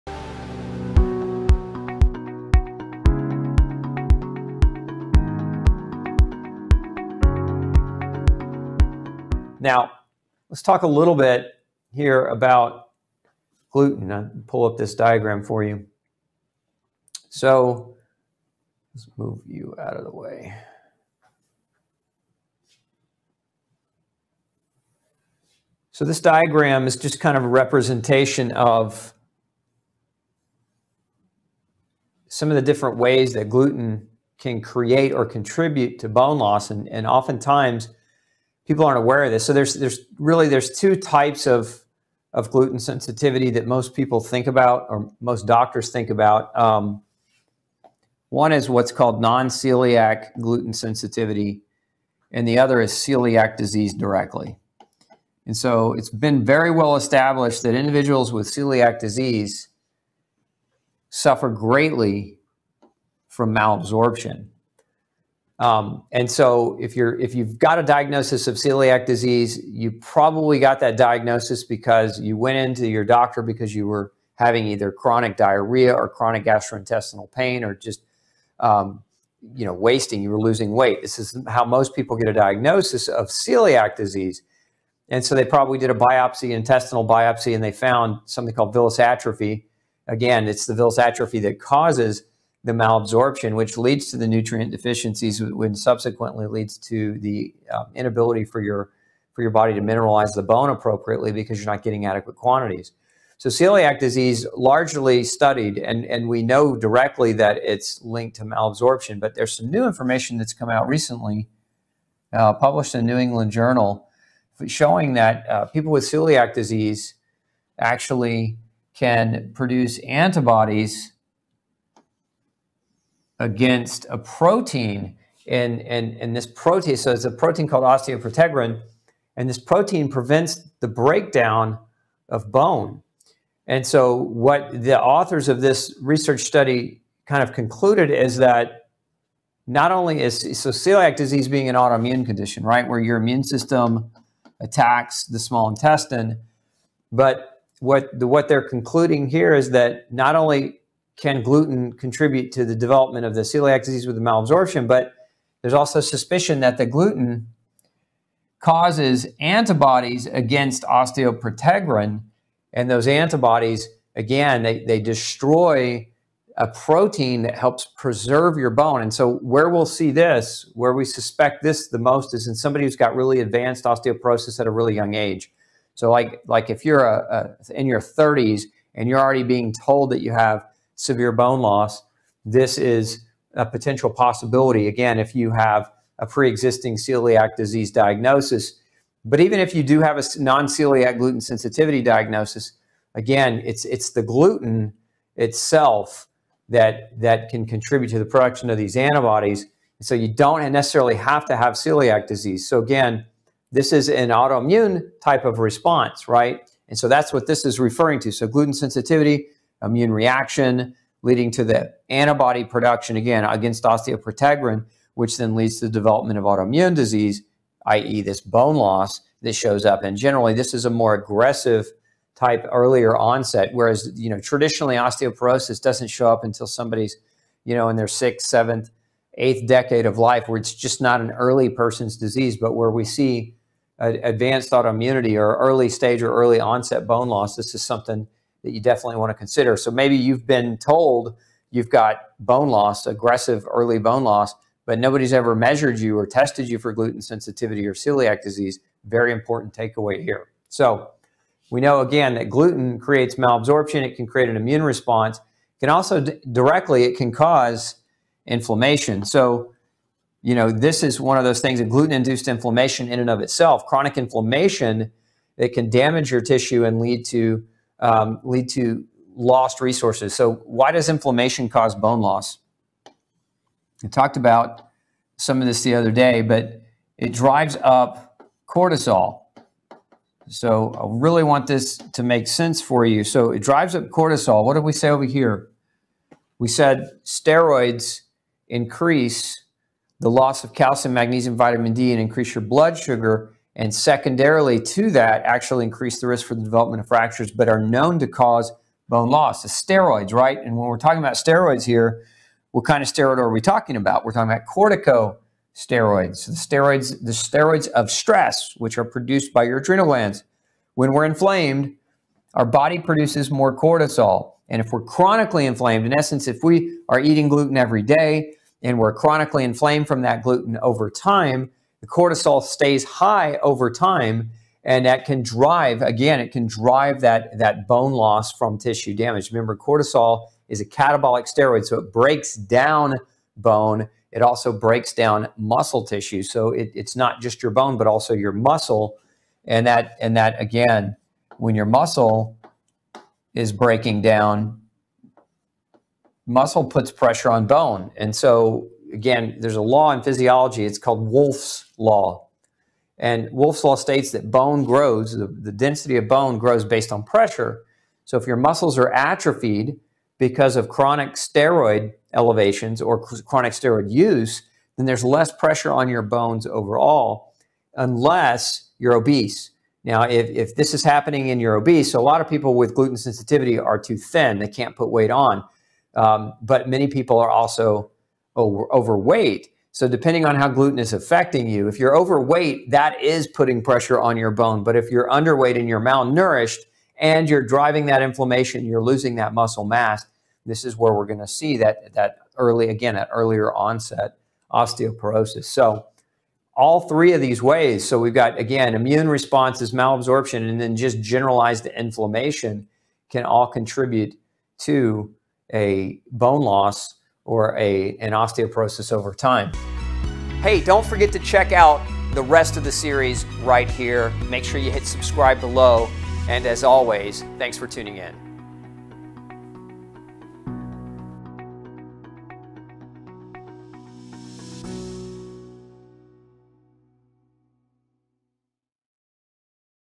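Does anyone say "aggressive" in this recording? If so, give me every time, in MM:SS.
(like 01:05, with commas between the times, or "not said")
03:41, 04:03.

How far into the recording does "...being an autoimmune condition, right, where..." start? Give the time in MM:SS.
02:21.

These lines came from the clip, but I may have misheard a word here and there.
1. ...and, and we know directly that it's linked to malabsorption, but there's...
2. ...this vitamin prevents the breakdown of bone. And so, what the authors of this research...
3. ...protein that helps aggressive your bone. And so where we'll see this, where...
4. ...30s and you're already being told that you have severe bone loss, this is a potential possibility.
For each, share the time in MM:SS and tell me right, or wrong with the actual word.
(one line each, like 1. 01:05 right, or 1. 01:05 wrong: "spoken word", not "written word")
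1. 01:45 right
2. 02:09 wrong: "protein", not "vitamin"
3. 02:46 wrong: "preserve", not "aggressive"
4. 02:58 right.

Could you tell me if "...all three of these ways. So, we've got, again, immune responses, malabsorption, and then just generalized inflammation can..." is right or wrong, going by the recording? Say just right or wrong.
right.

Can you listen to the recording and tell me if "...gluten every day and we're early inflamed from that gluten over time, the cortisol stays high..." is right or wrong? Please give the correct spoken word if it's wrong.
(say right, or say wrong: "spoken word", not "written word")
wrong: "chronically", not "early".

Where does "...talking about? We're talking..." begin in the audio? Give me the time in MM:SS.
05:03.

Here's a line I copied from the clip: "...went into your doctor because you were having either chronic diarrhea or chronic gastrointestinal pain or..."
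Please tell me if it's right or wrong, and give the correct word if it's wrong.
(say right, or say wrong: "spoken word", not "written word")
right.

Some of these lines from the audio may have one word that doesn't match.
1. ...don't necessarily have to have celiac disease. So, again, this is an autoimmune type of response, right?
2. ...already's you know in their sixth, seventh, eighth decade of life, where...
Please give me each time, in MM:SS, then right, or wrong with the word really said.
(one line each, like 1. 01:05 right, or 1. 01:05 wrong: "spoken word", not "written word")
1. 03:20 right
2. 03:46 wrong: "somebody", not "already".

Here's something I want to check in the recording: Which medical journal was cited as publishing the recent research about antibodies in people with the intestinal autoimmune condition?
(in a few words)
New England Journal.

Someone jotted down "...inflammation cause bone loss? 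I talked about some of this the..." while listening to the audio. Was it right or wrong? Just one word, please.
right.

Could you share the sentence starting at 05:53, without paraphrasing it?
And Wolff's law states that bone grows, the, the density of bone grows based on pressure.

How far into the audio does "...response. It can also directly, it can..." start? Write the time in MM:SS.
04:14.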